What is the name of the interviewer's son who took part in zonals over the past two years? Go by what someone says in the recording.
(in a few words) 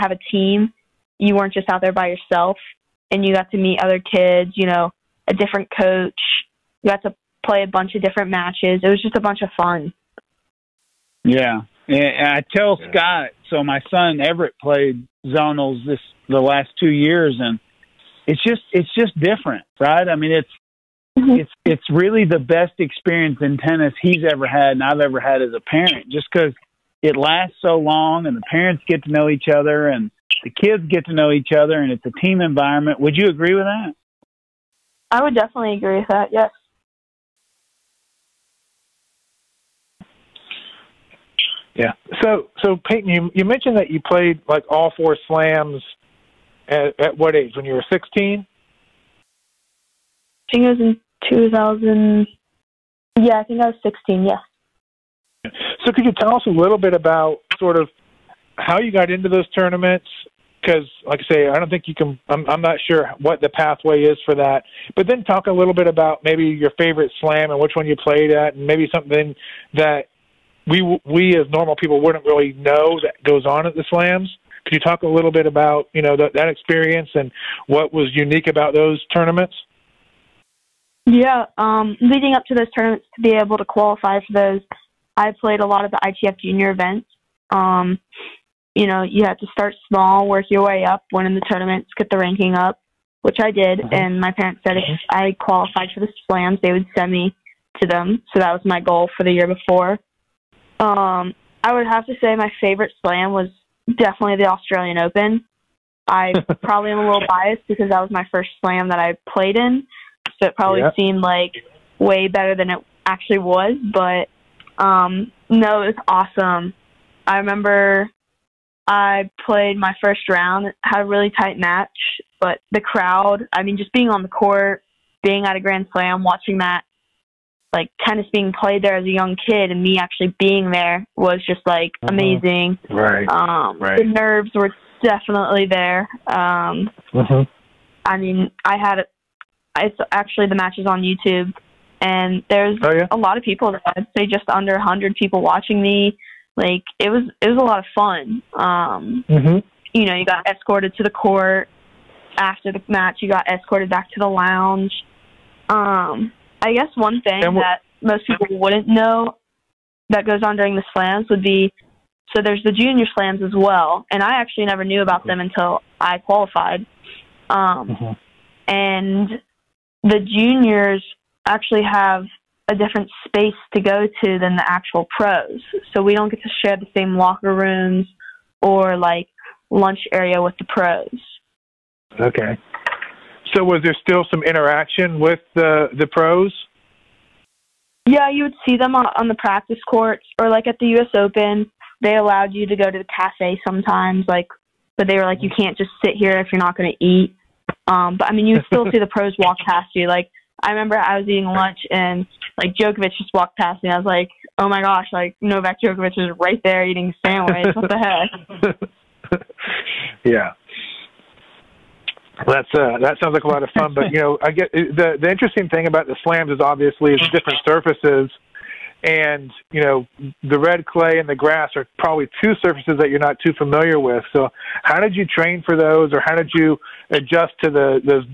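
Everett.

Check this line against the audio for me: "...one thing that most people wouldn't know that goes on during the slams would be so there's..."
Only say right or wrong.
right.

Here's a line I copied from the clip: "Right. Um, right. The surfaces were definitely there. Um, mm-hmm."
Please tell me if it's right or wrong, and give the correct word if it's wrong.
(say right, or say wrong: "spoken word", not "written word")
wrong: "nerves", not "surfaces".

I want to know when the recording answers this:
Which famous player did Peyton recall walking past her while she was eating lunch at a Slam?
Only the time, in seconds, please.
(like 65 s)
205 s.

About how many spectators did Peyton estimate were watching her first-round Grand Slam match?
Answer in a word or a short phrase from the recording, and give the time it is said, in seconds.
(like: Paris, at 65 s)
just under 100, at 144 s.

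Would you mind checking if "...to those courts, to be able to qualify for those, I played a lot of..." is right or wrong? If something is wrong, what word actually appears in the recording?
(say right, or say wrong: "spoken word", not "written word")
wrong: "tournaments", not "courts".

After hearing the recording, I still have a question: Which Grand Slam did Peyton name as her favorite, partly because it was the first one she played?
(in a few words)
Australian Open.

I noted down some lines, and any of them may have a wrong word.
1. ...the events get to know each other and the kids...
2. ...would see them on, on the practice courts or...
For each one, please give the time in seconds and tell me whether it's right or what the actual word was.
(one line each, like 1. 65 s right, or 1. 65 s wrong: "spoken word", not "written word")
1. 28 s wrong: "parents", not "events"
2. 188 s right.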